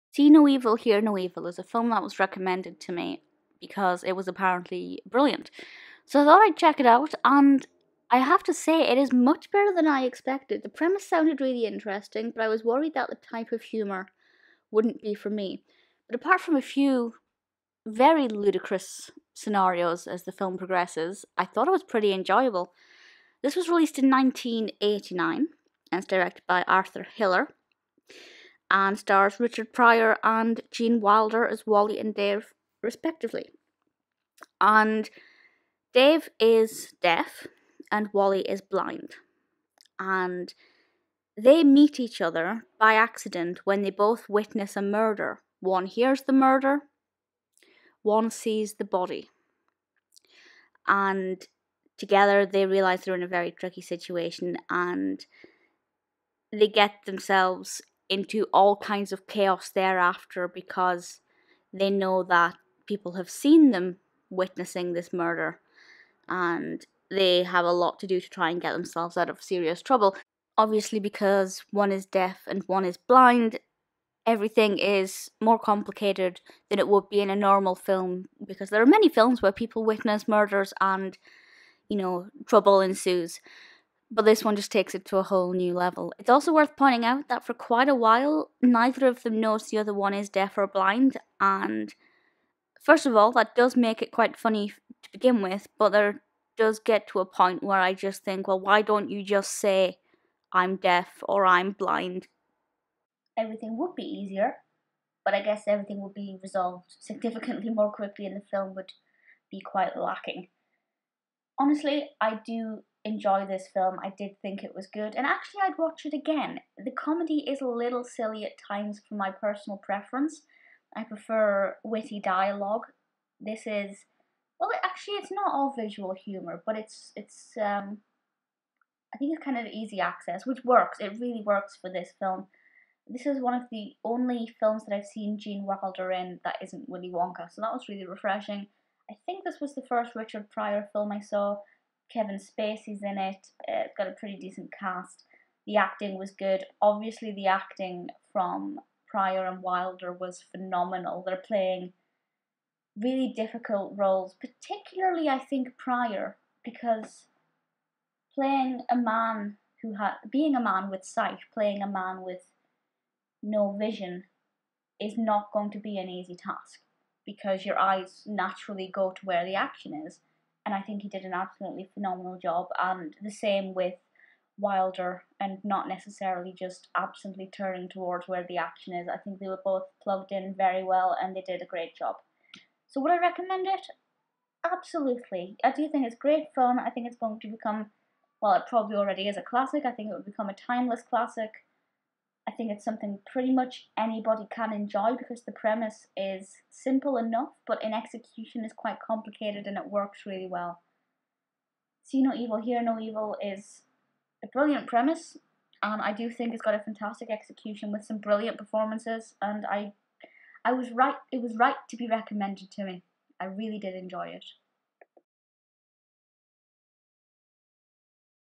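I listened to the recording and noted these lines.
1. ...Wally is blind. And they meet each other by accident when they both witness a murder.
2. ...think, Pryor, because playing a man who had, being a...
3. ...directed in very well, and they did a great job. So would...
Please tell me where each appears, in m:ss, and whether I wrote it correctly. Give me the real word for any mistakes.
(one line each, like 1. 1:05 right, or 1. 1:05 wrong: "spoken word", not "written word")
1. 0:38 right
2. 2:35 right
3. 3:00 wrong: "plugged", not "directed".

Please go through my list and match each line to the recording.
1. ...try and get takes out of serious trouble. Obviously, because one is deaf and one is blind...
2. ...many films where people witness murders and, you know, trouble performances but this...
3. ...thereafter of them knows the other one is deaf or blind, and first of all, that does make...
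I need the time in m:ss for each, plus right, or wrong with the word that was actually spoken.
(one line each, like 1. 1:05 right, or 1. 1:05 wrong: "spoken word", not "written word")
1. 1:08 wrong: "themselves", not "takes"
2. 1:18 wrong: "ensues", not "performances"
3. 1:28 wrong: "neither", not "thereafter".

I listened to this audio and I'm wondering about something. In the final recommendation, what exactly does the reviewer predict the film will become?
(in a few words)
A timeless classic.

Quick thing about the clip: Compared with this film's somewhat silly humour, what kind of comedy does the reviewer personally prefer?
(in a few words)
Witty dialogue.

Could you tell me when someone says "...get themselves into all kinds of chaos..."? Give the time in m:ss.
0:56.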